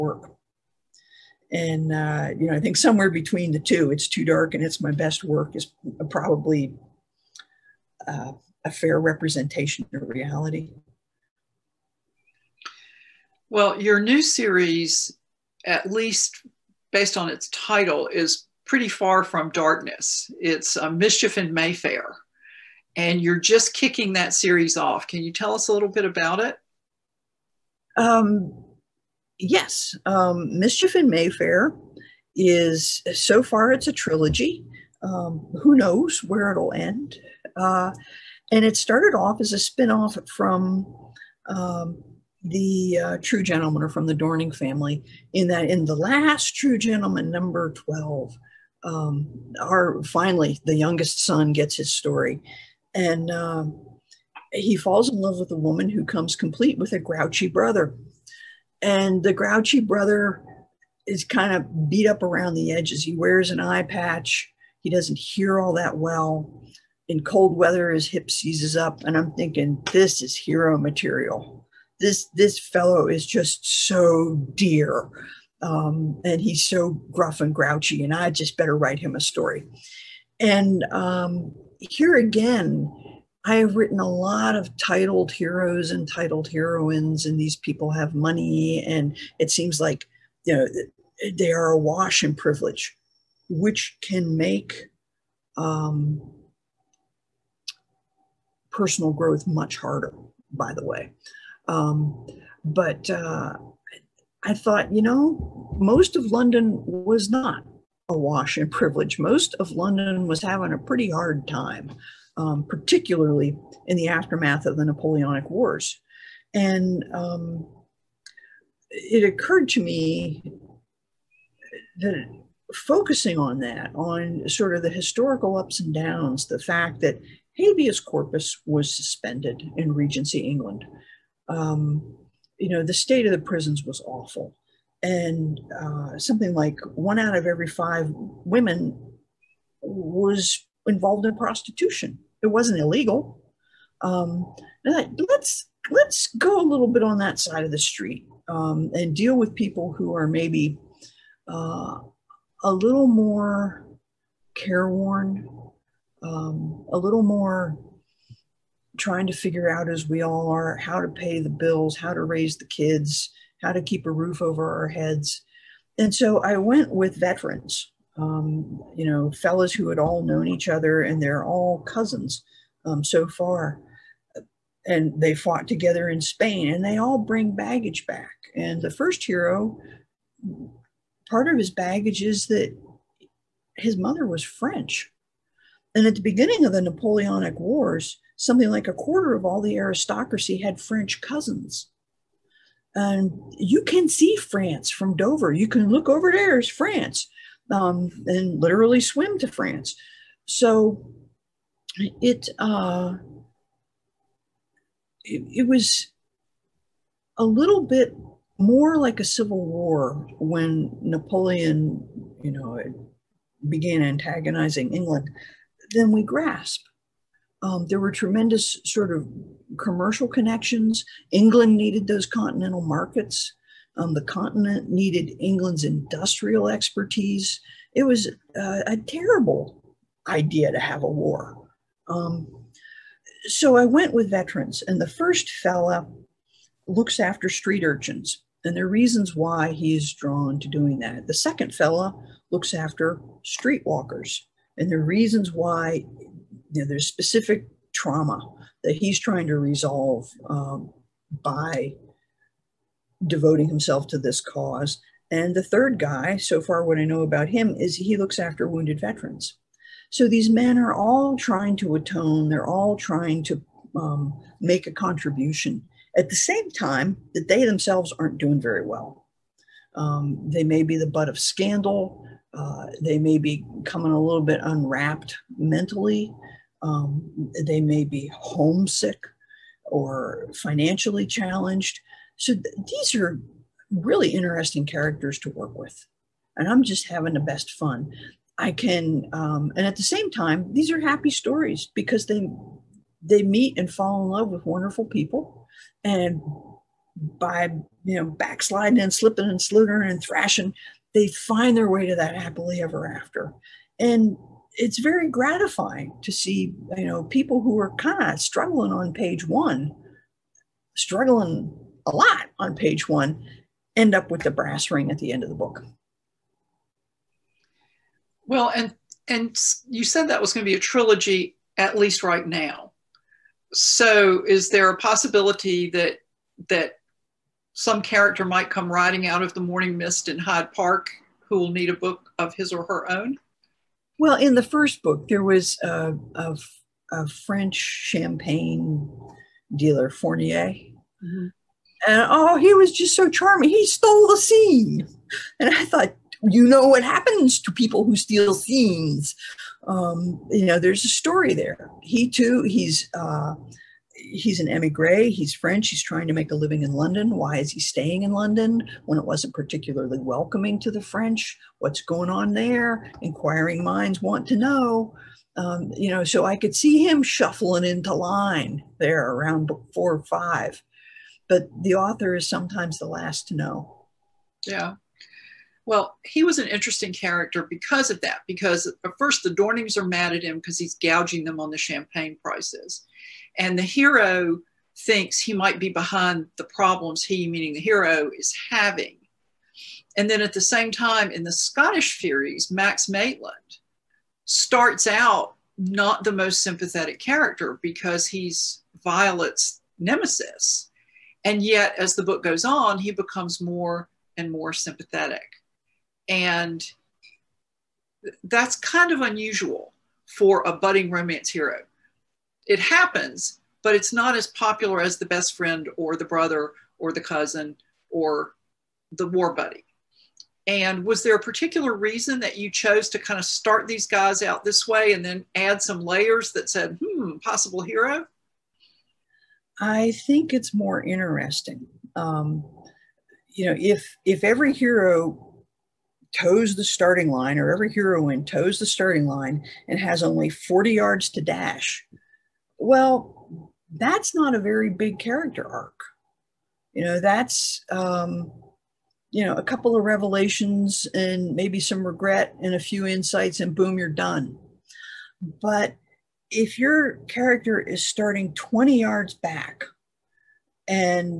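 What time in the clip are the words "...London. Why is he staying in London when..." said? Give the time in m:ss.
5:56.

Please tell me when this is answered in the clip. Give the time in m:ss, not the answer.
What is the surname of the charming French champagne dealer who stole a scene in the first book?
5:40.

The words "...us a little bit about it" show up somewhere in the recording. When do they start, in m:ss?
0:25.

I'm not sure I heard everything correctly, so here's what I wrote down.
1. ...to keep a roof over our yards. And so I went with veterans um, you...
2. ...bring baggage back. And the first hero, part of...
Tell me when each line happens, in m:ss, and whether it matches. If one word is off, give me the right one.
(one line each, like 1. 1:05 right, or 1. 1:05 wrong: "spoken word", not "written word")
1. 2:43 wrong: "heads", not "yards"
2. 2:57 right.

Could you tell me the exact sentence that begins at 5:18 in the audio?
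Well, and and you said that was going to be a trilogy at least right now.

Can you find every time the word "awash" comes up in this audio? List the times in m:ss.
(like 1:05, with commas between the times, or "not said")
1:31, 1:48.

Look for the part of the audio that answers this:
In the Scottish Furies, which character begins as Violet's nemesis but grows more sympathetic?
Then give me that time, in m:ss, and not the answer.
6:32.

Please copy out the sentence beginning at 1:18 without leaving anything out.
And I just better write him a story.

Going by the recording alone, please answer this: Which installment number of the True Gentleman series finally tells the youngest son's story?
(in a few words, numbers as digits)
12.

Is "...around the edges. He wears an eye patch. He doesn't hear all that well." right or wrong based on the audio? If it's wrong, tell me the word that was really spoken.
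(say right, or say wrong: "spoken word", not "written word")
right.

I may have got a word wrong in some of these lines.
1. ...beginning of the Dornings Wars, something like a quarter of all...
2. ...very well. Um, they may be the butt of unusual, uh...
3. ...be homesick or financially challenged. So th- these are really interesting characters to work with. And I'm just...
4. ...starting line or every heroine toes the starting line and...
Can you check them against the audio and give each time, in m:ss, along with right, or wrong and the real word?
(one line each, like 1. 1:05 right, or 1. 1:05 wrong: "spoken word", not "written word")
1. 3:06 wrong: "Napoleonic", not "Dornings"
2. 4:28 wrong: "scandal", not "unusual"
3. 4:38 right
4. 7:16 right.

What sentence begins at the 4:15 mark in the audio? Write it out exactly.
And the third guy, so far what I know about him, is he looks after wounded veterans.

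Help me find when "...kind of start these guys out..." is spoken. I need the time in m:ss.
7:03.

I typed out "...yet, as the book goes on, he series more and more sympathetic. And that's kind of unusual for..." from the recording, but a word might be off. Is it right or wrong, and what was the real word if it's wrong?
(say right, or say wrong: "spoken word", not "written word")
wrong: "becomes", not "series".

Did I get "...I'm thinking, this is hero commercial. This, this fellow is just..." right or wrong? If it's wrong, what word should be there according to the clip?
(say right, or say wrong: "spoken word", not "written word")
wrong: "material", not "commercial".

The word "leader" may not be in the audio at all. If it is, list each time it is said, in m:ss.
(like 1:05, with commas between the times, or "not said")
not said.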